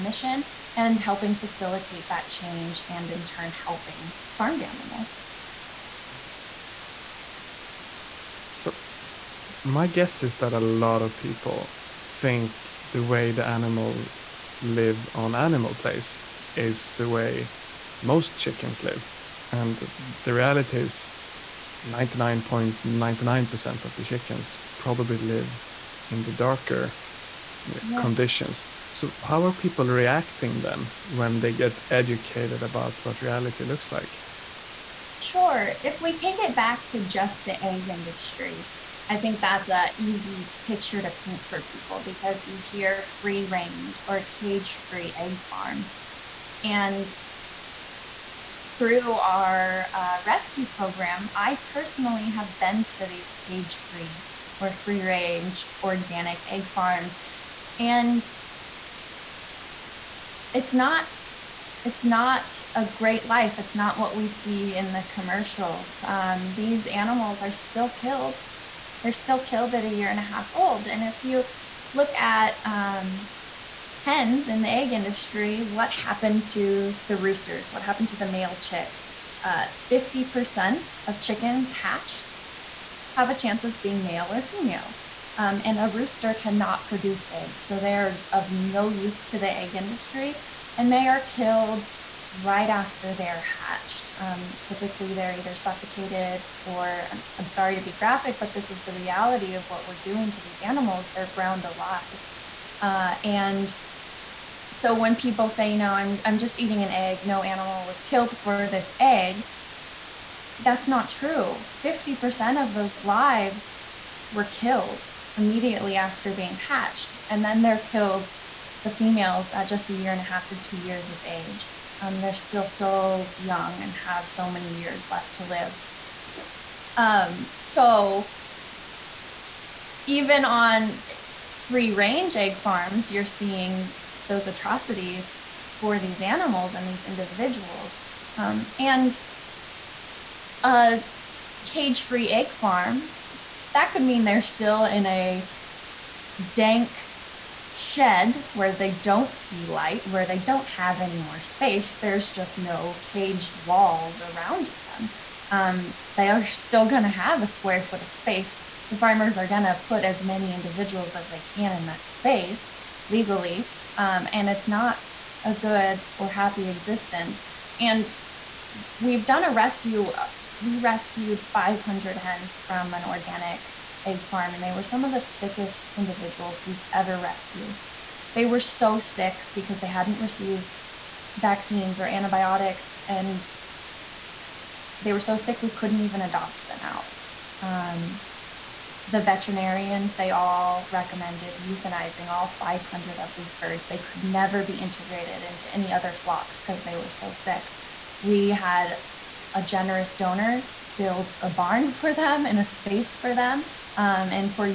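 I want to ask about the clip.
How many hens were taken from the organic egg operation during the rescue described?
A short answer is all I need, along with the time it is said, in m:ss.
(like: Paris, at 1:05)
500, at 2:51.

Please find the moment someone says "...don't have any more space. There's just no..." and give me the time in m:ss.
2:30.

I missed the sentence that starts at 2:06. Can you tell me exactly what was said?
Um, so even on free range egg farms, you're seeing those atrocities for these animals and these individuals.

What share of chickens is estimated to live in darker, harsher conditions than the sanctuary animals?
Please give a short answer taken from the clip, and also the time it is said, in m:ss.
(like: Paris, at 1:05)
99.99%, at 0:21.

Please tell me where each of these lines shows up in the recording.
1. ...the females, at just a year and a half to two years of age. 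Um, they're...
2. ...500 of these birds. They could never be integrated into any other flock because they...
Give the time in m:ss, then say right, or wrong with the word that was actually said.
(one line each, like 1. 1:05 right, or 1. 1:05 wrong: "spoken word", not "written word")
1. 1:58 right
2. 3:12 right.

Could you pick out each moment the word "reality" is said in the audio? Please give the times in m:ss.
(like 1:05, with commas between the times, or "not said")
0:20, 0:33, 1:38.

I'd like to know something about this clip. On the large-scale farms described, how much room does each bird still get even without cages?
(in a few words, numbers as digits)
a square foot.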